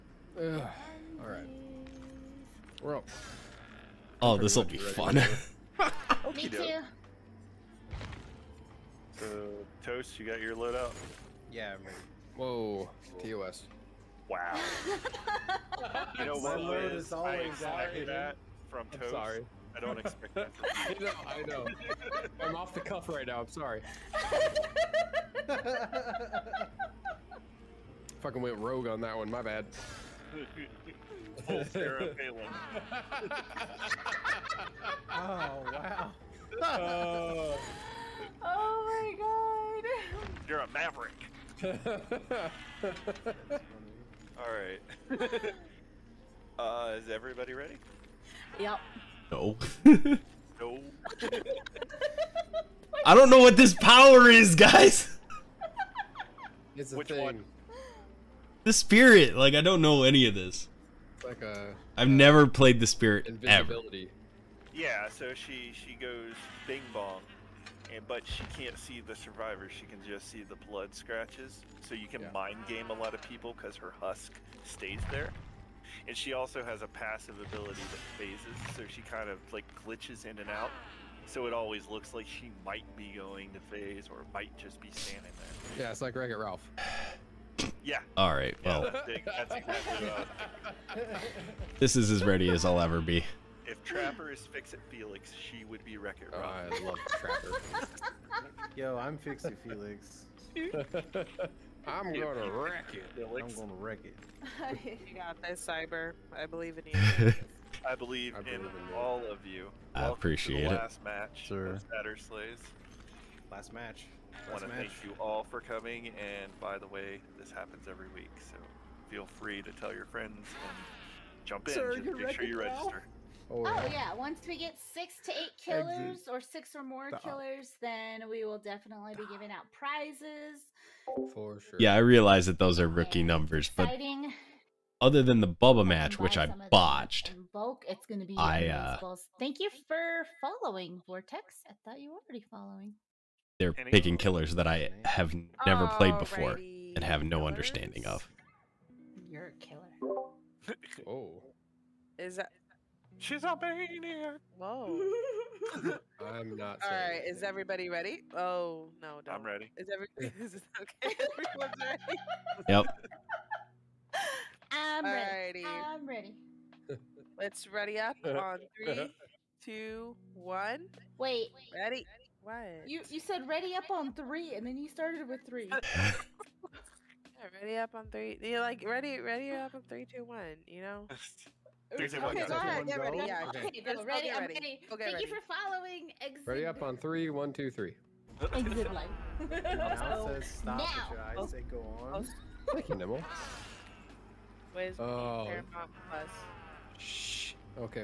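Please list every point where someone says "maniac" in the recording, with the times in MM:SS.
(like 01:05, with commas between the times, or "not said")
02:33.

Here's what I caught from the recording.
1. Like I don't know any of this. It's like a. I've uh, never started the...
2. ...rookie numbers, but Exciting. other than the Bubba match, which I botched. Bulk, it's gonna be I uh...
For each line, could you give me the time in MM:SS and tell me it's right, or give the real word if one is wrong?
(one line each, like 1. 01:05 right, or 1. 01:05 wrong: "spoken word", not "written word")
1. 00:59 wrong: "played", not "started"
2. 02:12 right.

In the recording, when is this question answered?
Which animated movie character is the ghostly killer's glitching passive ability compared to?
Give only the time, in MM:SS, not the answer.
01:26.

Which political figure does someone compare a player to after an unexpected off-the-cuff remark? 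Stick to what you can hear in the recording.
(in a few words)
Sarah Palin.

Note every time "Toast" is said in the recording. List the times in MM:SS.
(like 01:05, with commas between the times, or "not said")
00:09, 00:18.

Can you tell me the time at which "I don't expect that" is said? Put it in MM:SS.
00:19.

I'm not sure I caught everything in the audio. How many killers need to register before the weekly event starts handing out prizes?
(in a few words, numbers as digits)
6 to 8.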